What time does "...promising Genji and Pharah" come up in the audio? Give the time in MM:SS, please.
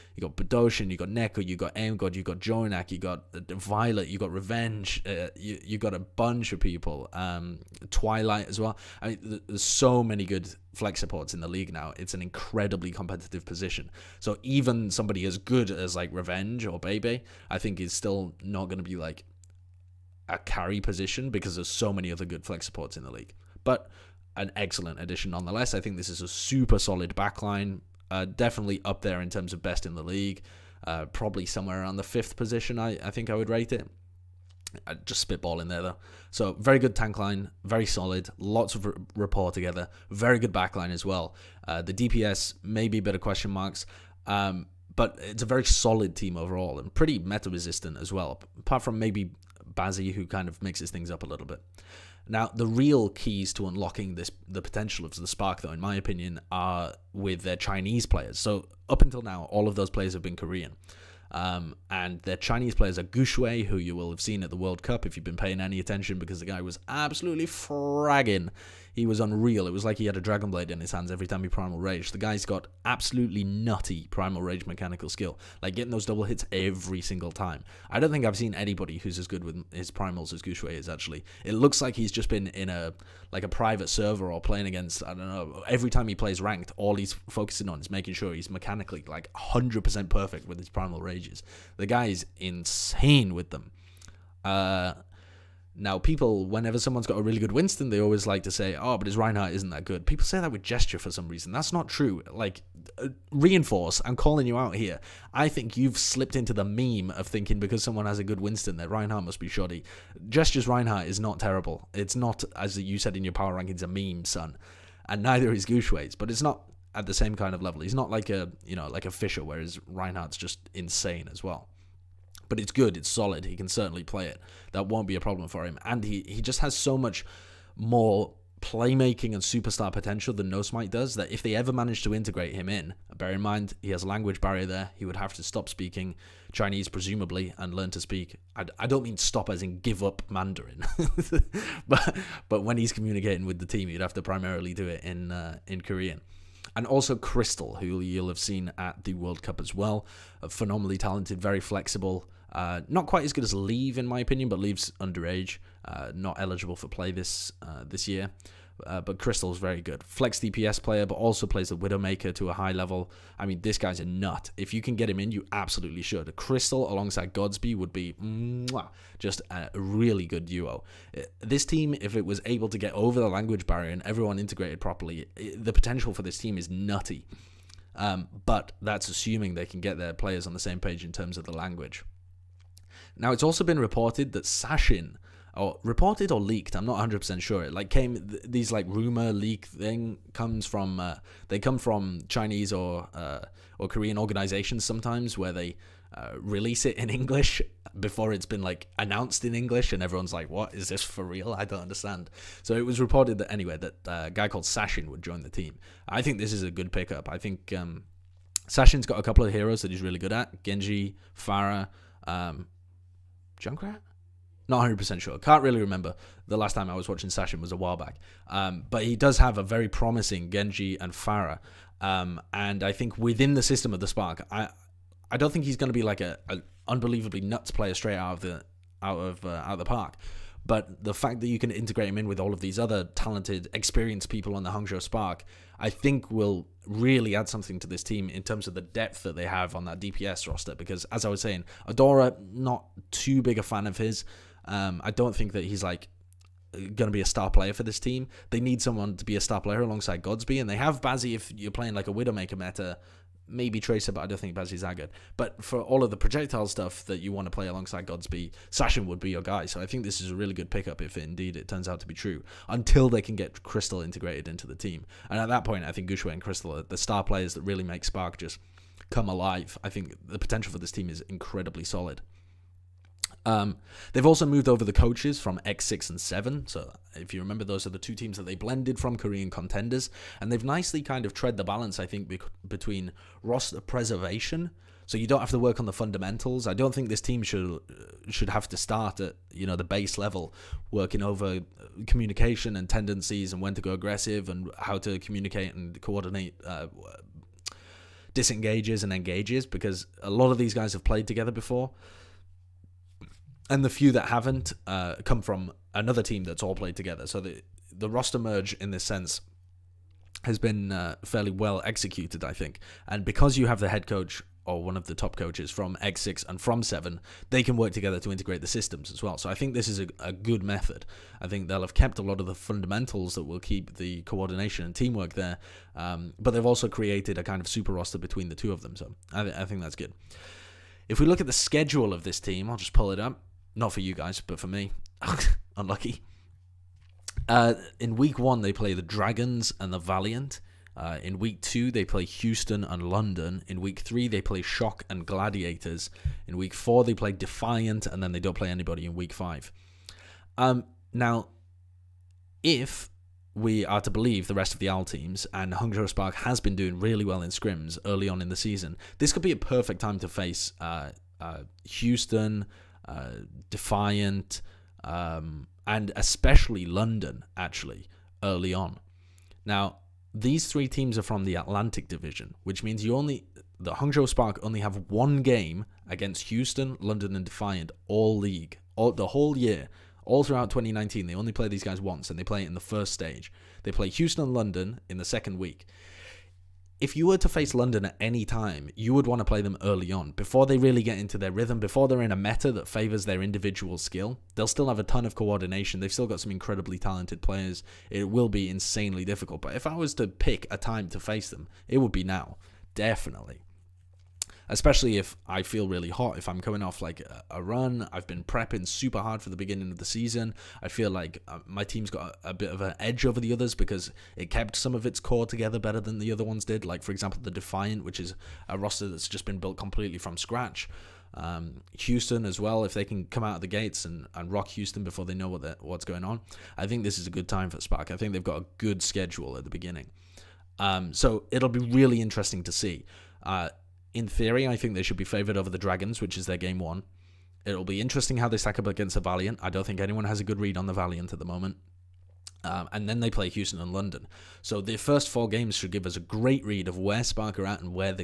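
03:39.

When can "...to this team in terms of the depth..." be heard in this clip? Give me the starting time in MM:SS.
03:57.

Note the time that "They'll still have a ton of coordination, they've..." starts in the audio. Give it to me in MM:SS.
06:34.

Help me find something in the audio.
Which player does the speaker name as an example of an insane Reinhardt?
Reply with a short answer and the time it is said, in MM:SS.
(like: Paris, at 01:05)
Fissure, at 01:59.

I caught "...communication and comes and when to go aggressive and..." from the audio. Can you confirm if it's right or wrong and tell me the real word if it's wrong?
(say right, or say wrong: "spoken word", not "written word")
wrong: "tendencies", not "comes".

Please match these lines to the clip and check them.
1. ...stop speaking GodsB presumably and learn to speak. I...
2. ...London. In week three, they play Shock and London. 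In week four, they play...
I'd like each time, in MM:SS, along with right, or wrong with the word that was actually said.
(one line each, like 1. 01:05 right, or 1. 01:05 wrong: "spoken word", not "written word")
1. 02:15 wrong: "Chinese", not "GodsB"
2. 05:43 wrong: "Gladiators", not "London".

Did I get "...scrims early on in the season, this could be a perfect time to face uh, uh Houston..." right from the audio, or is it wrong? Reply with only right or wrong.
right.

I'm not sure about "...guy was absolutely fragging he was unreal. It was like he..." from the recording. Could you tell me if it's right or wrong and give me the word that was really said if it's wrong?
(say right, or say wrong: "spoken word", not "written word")
right.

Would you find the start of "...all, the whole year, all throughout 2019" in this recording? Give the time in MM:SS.
06:18.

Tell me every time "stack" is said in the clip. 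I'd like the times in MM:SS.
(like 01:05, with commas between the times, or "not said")
07:18.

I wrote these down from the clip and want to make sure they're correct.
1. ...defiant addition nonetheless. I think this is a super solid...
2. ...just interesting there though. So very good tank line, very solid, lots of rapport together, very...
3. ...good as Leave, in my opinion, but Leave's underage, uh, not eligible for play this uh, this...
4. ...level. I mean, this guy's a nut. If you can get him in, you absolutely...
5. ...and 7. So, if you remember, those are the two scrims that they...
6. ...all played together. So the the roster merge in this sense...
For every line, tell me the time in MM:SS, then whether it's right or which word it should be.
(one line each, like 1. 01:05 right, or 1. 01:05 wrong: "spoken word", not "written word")
1. 00:24 wrong: "excellent", not "defiant"
2. 00:35 wrong: "spitballing", not "interesting"
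3. 02:33 right
4. 02:42 right
5. 04:36 wrong: "teams", not "scrims"
6. 05:06 right.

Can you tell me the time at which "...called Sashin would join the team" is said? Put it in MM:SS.
03:24.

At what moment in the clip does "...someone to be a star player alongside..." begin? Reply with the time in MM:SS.
04:08.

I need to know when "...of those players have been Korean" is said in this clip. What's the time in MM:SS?
00:59.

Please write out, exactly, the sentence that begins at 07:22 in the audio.
Um, and then they play Houston and London.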